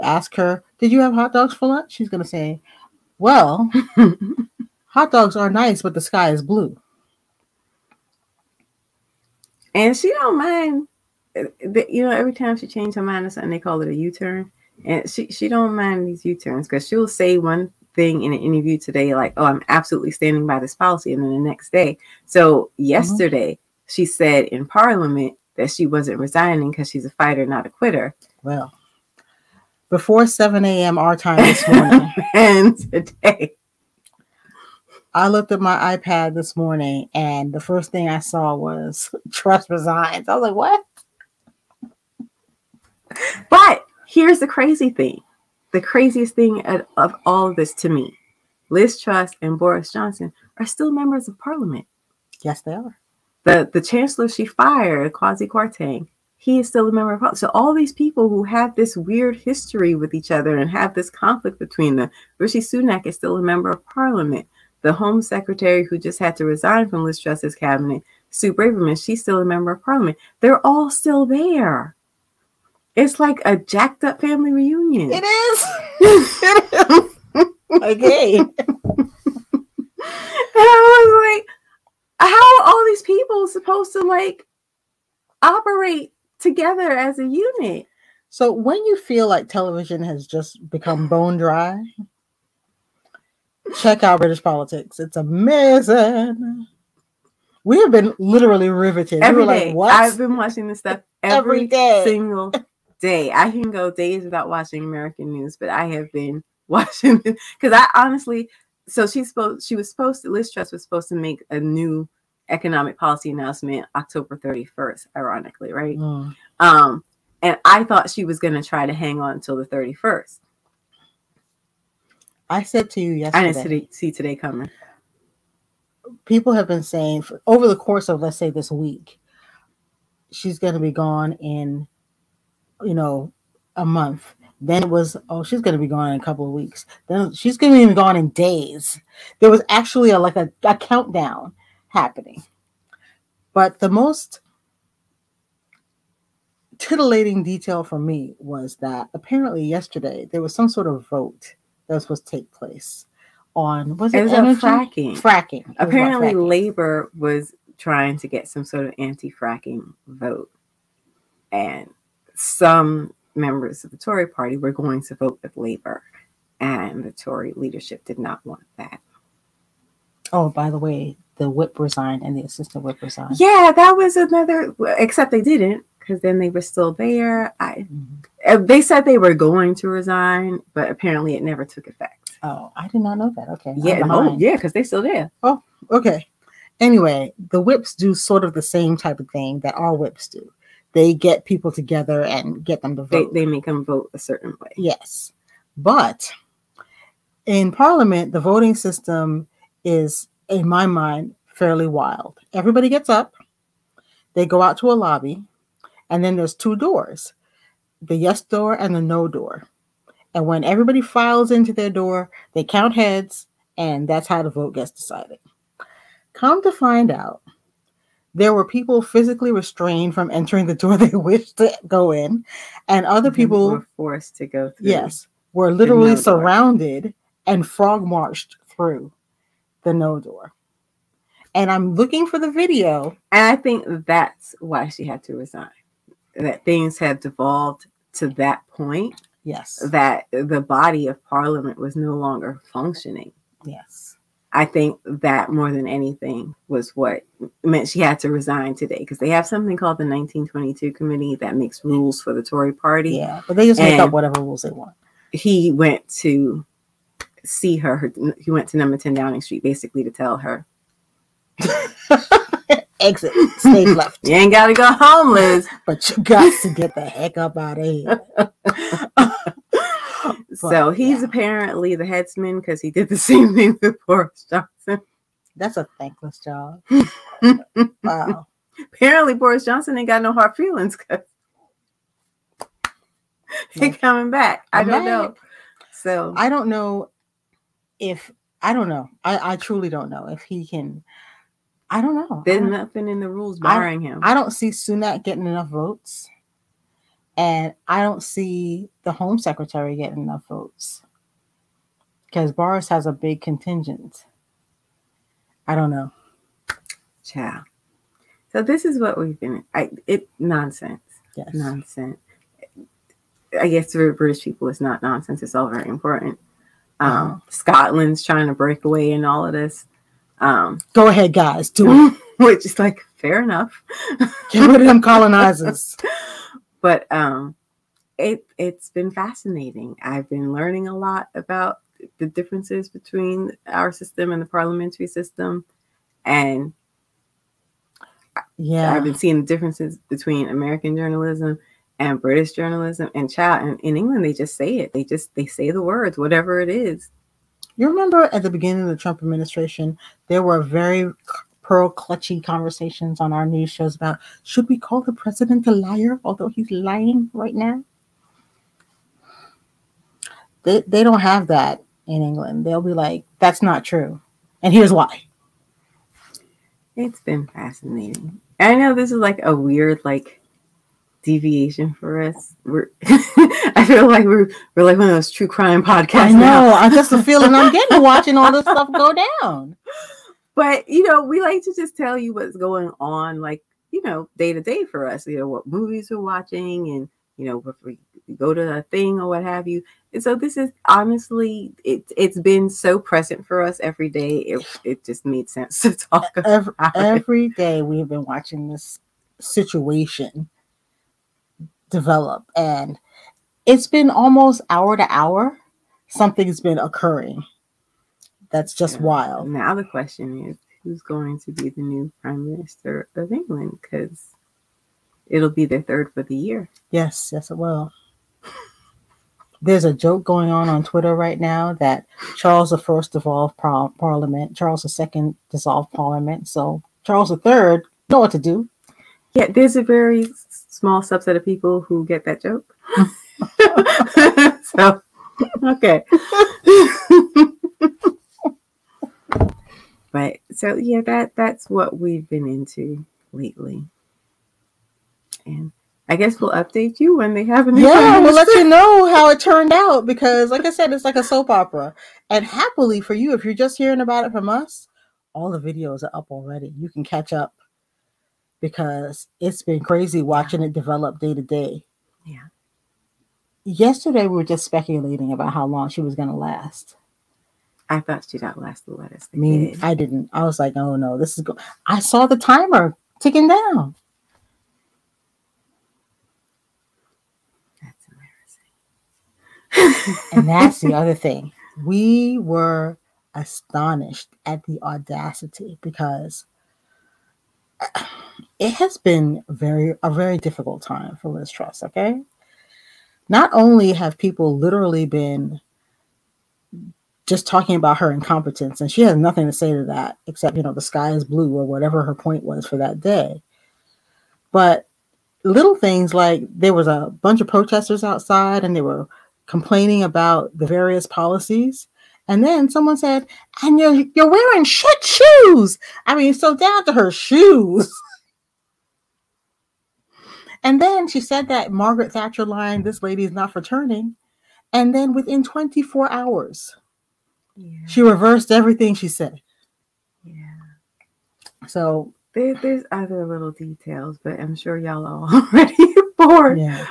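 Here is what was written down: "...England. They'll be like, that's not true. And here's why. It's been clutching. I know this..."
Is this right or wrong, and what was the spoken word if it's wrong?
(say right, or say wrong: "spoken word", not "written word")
wrong: "fascinating", not "clutching".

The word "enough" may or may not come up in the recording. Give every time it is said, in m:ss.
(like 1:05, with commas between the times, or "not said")
4:55, 5:00, 5:23.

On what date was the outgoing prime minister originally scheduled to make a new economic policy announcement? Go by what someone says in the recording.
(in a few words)
October 31st.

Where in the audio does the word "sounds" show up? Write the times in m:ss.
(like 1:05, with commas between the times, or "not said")
not said.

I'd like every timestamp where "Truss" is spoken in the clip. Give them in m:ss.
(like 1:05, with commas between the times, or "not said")
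0:39, 0:48, 1:07, 1:50, 8:11.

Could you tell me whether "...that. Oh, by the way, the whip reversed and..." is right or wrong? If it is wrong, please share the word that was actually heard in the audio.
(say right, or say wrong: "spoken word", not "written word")
wrong: "resigned", not "reversed".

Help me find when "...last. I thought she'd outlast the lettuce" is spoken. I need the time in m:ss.
7:46.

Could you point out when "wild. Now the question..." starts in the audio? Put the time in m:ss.
6:49.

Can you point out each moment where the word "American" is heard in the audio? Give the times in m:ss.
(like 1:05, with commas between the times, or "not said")
1:44, 5:40.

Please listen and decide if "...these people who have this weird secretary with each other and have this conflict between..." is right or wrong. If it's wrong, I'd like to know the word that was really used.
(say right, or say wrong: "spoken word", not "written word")
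wrong: "history", not "secretary".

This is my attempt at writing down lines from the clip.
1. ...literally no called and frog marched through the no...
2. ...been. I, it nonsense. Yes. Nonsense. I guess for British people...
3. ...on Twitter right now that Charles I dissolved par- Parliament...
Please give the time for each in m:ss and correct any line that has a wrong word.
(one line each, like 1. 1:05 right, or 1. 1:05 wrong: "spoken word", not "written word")
1. 3:45 wrong: "surrounded", not "called"
2. 5:09 right
3. 7:00 right.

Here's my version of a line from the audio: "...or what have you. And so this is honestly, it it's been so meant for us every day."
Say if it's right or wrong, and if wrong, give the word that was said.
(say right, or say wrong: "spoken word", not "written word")
wrong: "present", not "meant".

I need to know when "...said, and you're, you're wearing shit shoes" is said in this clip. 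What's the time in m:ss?
8:32.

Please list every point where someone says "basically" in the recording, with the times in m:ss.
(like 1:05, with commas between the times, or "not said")
4:19.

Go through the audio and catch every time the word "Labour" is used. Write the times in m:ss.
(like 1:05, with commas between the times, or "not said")
2:36, 2:45.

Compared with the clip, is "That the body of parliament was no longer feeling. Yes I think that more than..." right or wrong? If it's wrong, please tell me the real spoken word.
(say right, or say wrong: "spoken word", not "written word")
wrong: "functioning", not "feeling".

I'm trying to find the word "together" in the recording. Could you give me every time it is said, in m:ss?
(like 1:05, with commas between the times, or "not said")
1:26, 3:11.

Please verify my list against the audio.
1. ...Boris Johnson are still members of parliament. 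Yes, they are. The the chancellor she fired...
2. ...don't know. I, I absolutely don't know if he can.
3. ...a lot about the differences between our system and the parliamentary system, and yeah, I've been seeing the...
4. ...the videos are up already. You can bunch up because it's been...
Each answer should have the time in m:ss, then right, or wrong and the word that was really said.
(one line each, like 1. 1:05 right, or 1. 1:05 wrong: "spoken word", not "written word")
1. 0:49 right
2. 4:48 wrong: "truly", not "absolutely"
3. 5:30 right
4. 7:35 wrong: "catch", not "bunch".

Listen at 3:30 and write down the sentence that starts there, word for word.
And when everybody files into their door, they count heads, and that's how the vote gets decided.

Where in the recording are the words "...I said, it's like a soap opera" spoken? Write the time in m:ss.
7:30.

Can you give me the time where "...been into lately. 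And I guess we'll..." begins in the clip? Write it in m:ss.
7:22.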